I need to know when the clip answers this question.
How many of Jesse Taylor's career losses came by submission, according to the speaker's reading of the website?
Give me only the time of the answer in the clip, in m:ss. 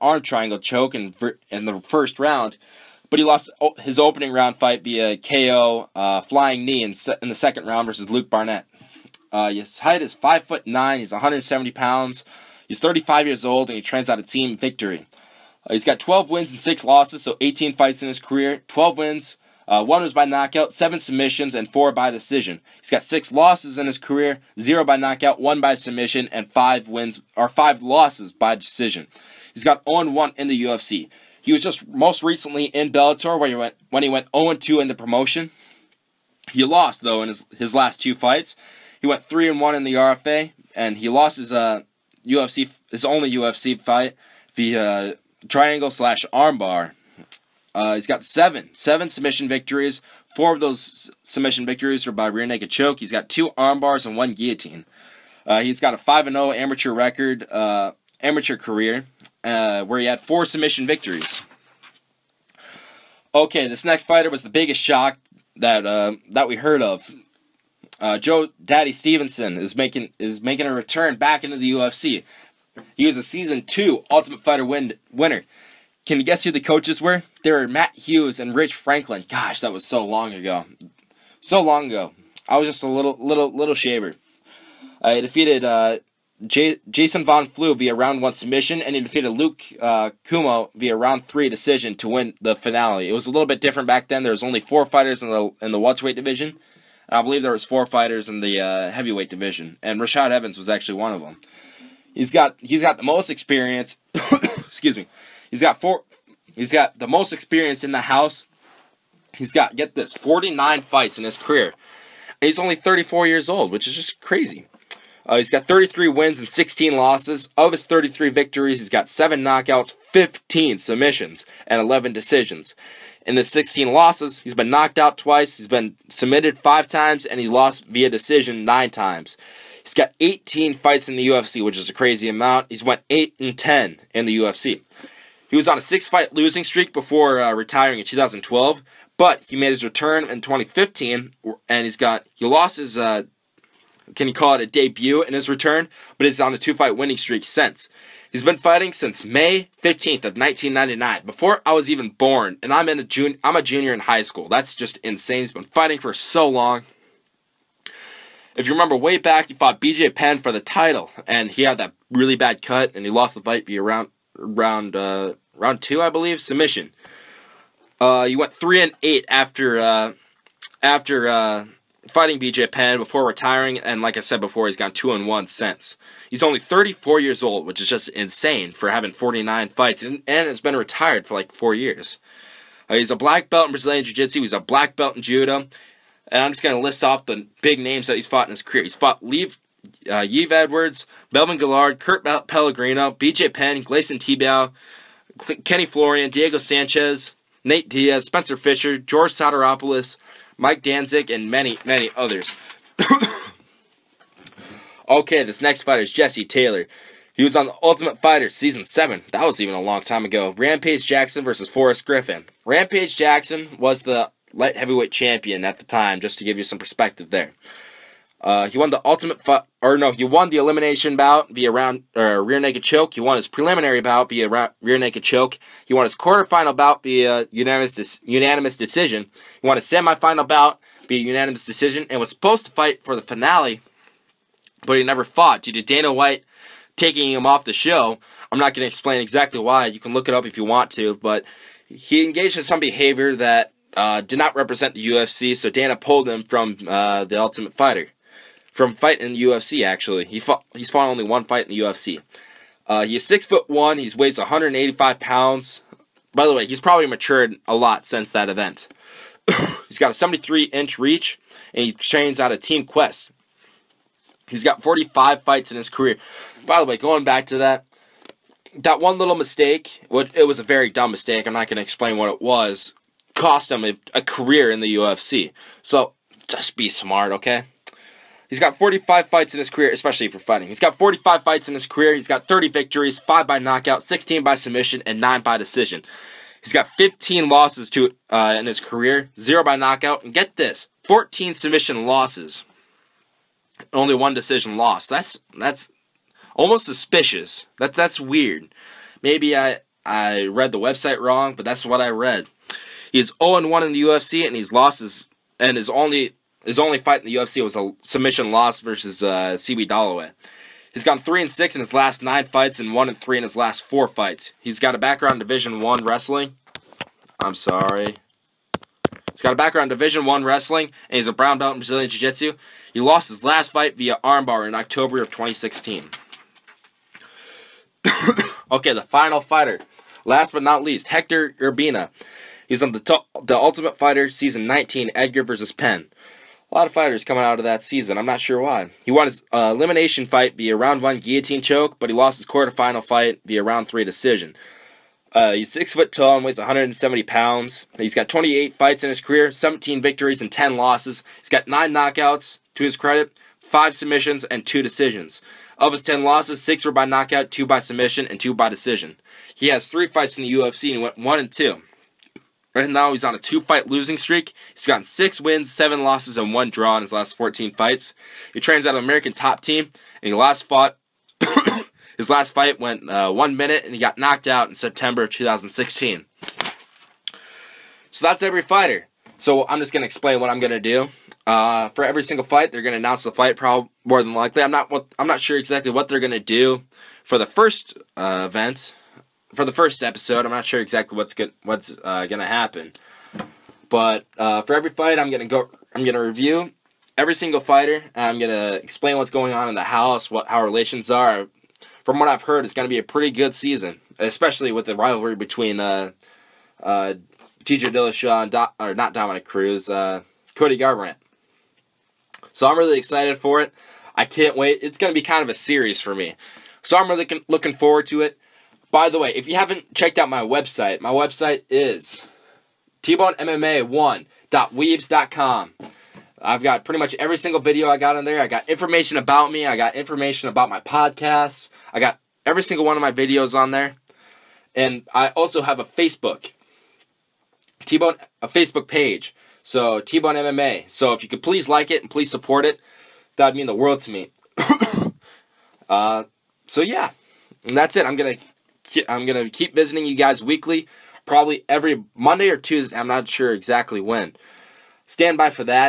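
4:51.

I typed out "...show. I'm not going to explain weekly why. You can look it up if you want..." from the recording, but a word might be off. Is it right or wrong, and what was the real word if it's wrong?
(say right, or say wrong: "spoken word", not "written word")
wrong: "exactly", not "weekly".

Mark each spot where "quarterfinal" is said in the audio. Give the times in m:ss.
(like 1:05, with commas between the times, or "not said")
3:46, 5:42.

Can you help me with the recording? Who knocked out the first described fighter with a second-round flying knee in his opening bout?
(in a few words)
Luke Barnatt.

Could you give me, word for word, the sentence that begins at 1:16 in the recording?
Can you guess who the coaches were?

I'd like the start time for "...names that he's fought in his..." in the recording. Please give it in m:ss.
3:07.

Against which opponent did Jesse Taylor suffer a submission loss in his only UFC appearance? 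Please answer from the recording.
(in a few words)
CB Dollaway.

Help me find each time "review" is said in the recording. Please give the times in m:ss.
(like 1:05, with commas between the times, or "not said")
6:36.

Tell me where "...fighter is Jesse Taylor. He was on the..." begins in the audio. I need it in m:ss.
3:25.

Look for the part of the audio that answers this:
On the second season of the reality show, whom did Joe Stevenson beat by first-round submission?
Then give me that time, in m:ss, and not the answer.
1:26.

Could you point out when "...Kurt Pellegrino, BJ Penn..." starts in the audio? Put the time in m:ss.
3:11.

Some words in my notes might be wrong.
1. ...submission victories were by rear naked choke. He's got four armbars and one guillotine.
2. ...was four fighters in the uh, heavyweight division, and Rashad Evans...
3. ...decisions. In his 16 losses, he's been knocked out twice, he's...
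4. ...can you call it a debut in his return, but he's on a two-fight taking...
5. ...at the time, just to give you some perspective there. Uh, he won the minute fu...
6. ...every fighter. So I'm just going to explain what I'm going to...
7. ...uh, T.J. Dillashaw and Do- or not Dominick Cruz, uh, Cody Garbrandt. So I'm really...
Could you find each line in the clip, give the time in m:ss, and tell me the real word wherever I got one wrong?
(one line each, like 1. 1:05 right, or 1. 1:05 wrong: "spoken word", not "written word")
1. 0:51 wrong: "two", not "four"
2. 1:37 right
3. 2:02 right
4. 2:24 wrong: "winning", not "taking"
5. 3:35 wrong: "ultimate", not "minute"
6. 6:18 right
7. 6:46 right.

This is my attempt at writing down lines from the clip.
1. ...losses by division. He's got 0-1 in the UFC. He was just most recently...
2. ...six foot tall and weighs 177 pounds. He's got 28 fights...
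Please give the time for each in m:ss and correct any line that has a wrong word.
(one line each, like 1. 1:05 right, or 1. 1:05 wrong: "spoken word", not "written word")
1. 0:27 wrong: "decision", not "division"
2. 5:45 wrong: "170", not "177".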